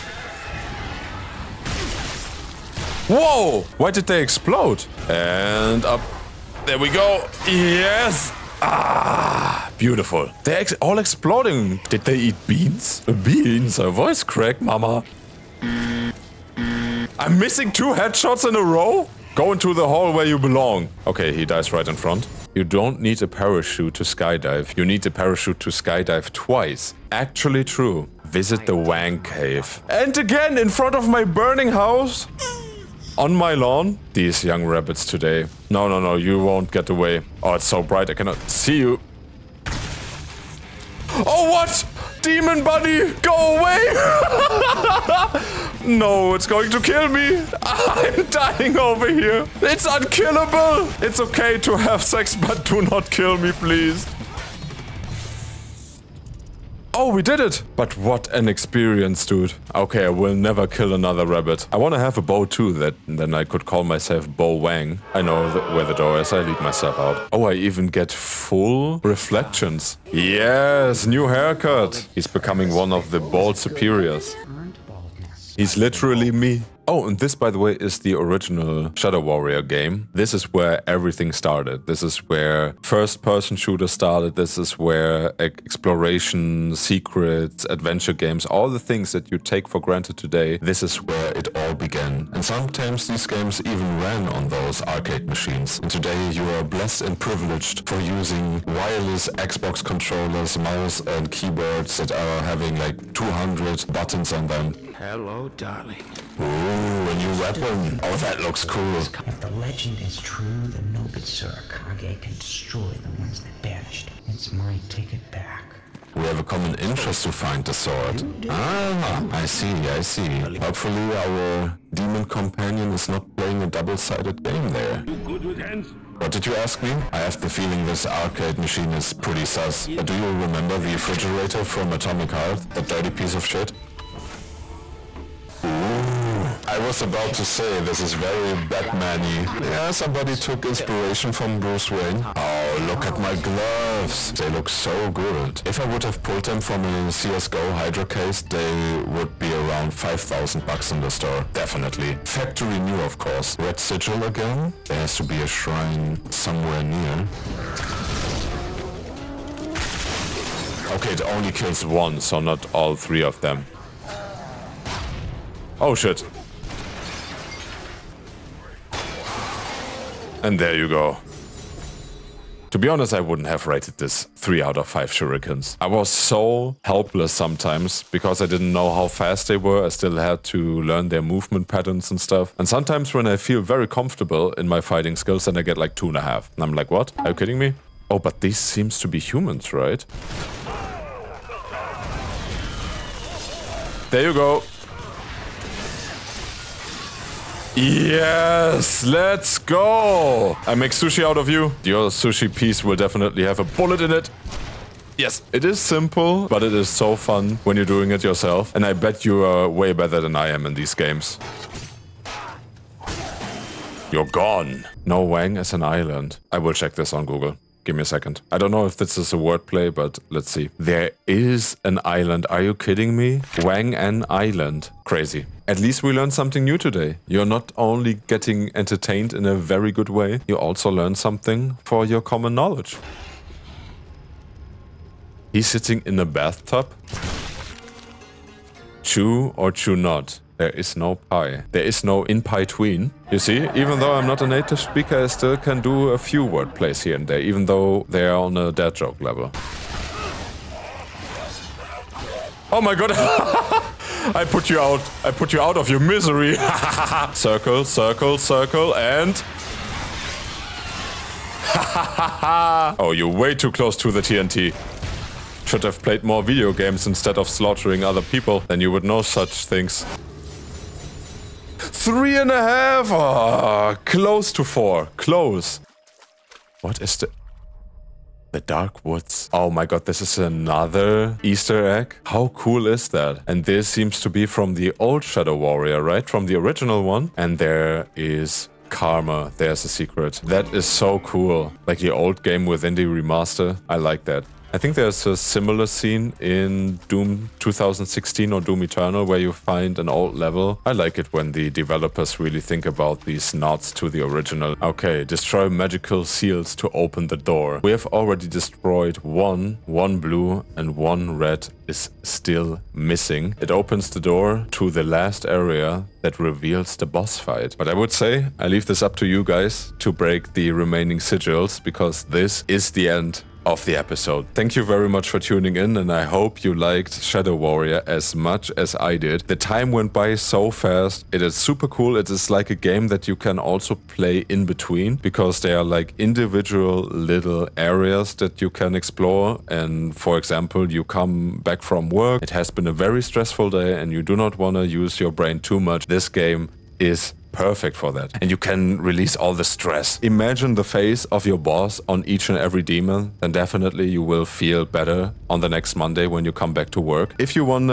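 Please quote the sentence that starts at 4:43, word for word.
And this seems to be from the old Shadow Warrior, right?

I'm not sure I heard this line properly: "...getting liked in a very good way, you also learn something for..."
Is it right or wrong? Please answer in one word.
wrong.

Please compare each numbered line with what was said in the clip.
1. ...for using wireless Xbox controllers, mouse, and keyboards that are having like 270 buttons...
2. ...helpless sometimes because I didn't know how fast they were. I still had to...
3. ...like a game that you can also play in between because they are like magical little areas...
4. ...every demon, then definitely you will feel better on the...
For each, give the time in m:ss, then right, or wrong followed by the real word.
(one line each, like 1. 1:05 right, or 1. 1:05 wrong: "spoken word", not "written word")
1. 1:37 wrong: "200", not "270"
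2. 2:56 right
3. 5:32 wrong: "individual", not "magical"
4. 5:52 right.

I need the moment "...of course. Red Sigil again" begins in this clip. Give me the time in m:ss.
2:33.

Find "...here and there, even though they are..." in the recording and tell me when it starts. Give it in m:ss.
4:07.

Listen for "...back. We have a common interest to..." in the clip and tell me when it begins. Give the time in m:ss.
1:55.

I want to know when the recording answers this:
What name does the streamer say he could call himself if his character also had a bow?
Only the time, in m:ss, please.
1:04.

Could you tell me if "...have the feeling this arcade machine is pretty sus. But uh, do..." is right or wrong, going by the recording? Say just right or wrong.
right.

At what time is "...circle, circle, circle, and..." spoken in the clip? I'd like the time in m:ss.
4:17.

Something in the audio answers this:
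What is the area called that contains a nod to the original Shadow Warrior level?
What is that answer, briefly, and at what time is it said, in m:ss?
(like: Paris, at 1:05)
The Dark Woods, at 4:38.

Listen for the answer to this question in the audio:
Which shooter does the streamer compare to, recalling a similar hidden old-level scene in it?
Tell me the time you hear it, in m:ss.
4:57.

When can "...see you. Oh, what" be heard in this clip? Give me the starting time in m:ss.
0:38.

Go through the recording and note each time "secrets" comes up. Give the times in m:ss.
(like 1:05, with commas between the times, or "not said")
1:26, 4:49.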